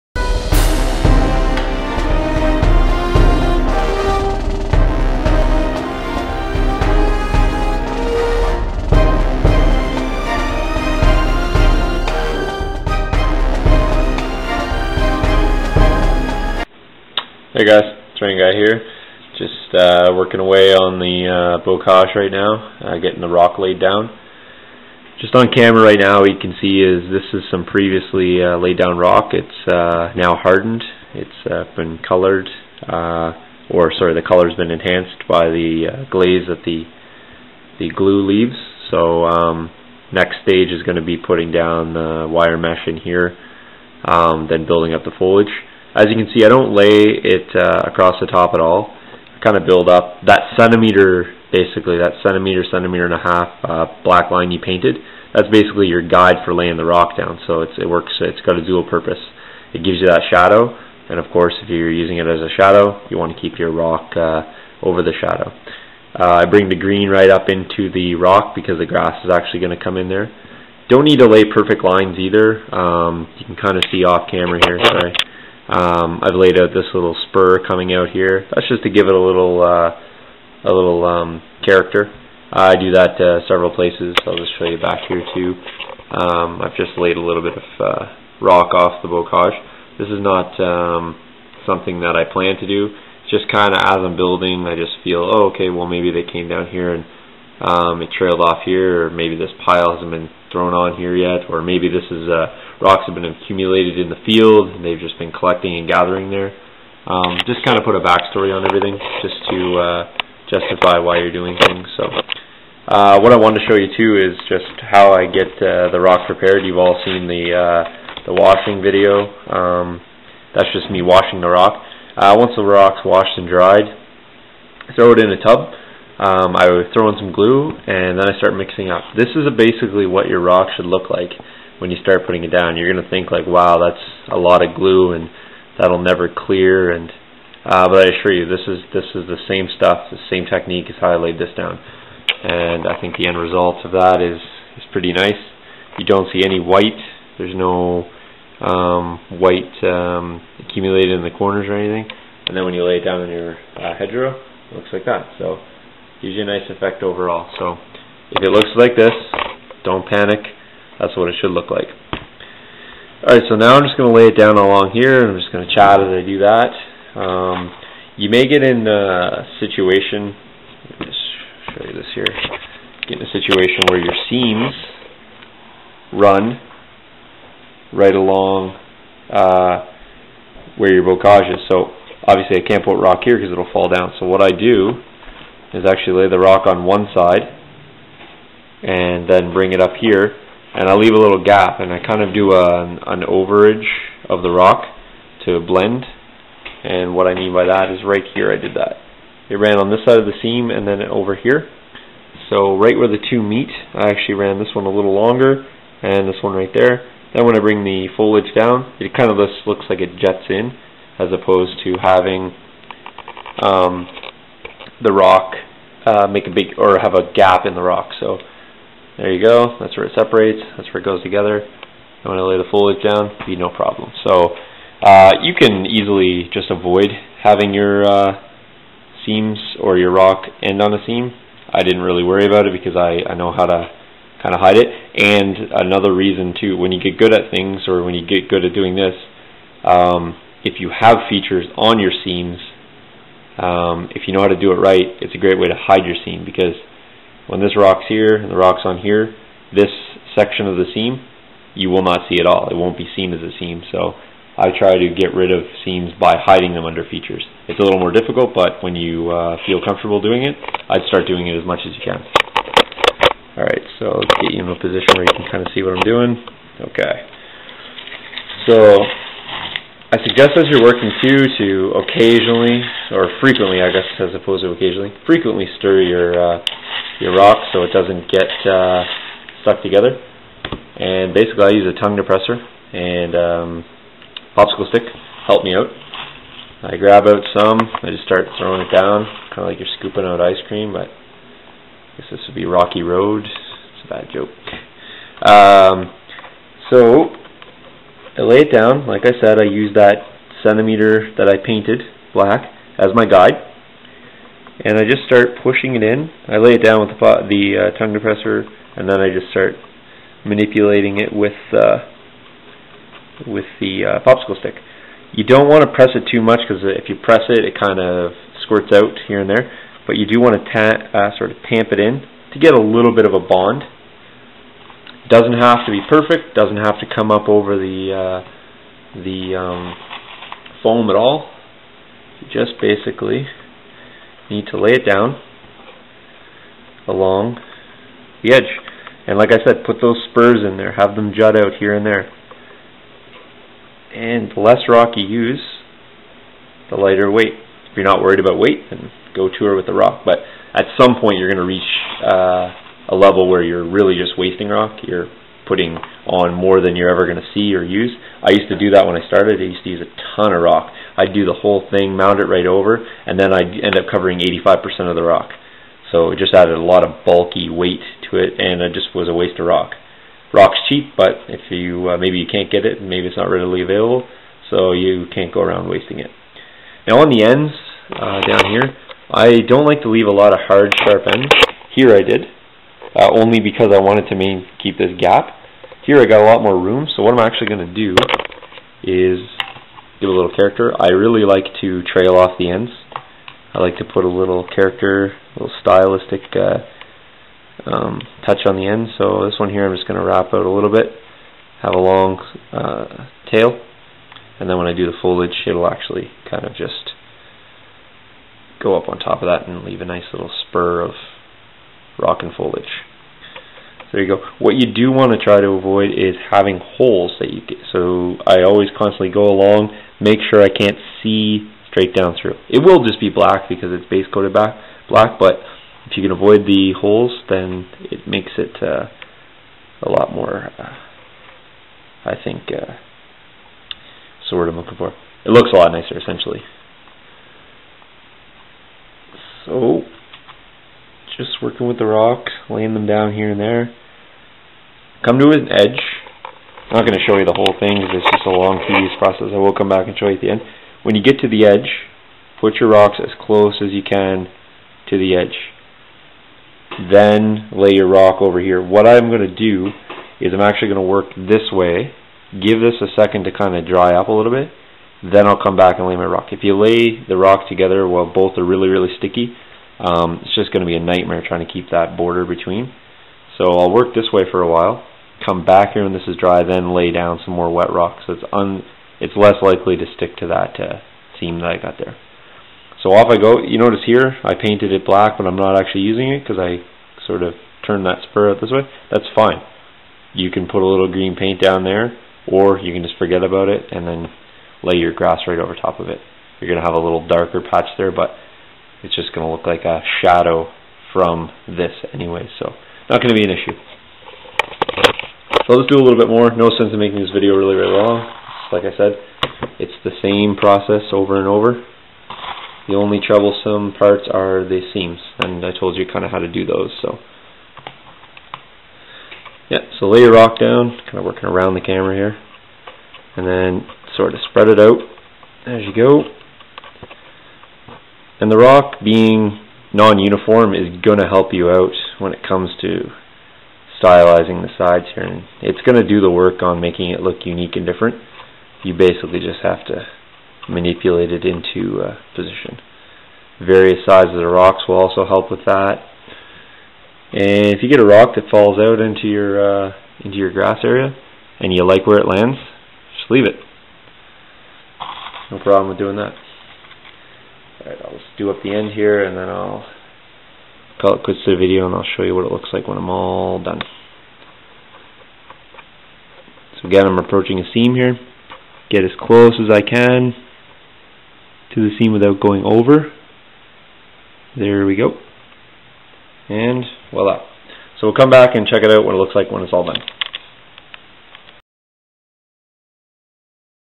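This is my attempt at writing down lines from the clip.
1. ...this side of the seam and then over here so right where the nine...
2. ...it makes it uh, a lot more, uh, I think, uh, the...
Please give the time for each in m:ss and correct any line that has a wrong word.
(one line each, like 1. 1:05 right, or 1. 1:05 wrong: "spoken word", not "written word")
1. 3:19 wrong: "two", not "nine"
2. 7:08 right.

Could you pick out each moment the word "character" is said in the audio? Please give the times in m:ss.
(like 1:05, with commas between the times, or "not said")
1:21, 6:30, 6:34.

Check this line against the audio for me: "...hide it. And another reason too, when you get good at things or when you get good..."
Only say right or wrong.
right.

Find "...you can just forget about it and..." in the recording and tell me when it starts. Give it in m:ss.
8:12.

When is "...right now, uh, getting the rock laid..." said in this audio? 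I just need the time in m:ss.
0:22.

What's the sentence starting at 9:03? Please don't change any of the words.
Various sizes of rocks will also help with that.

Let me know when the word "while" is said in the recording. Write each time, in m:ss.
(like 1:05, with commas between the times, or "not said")
7:48, 7:54.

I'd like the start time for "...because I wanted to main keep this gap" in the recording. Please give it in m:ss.
6:23.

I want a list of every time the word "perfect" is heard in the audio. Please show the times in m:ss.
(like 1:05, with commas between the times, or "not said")
1:11, 5:26.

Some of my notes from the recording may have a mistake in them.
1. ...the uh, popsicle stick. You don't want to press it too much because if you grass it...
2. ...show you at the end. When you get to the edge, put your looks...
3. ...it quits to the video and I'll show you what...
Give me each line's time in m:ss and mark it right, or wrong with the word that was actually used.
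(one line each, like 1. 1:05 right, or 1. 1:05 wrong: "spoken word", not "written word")
1. 5:13 wrong: "press", not "grass"
2. 7:30 wrong: "rocks", not "looks"
3. 9:21 right.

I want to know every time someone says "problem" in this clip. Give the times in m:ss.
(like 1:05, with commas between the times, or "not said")
3:43, 9:15.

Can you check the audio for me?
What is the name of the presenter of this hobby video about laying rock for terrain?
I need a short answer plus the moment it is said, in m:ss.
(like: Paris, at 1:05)
Guy, at 0:18.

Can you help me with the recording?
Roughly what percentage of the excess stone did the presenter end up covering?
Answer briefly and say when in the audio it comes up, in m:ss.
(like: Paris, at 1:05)
85%, at 6:04.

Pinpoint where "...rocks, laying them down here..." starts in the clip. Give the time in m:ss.
7:22.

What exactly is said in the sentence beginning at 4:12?
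It won't be seen as a seam.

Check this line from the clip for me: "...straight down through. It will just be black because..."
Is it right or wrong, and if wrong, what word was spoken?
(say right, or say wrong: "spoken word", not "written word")
right.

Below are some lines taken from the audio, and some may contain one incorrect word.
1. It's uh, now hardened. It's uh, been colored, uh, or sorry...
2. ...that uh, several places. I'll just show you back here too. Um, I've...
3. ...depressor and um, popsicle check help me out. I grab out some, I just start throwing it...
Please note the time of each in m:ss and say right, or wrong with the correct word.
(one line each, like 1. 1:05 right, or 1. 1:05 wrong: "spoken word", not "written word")
1. 0:29 right
2. 1:22 right
3. 4:42 wrong: "stick", not "check".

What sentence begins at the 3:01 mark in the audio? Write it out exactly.
So obviously I can't put rock here because it'll fall down.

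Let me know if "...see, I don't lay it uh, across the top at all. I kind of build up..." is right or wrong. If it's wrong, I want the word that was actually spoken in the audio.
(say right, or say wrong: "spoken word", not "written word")
right.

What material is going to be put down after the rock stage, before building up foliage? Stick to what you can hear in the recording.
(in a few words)
wire mesh.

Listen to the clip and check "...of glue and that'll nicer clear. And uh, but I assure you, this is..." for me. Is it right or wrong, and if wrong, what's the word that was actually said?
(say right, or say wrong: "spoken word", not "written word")
wrong: "never", not "nicer".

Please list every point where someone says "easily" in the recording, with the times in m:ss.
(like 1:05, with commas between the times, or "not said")
3:45.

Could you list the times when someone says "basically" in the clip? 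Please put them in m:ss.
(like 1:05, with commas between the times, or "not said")
0:51, 0:55, 2:09, 4:41, 5:32, 8:58.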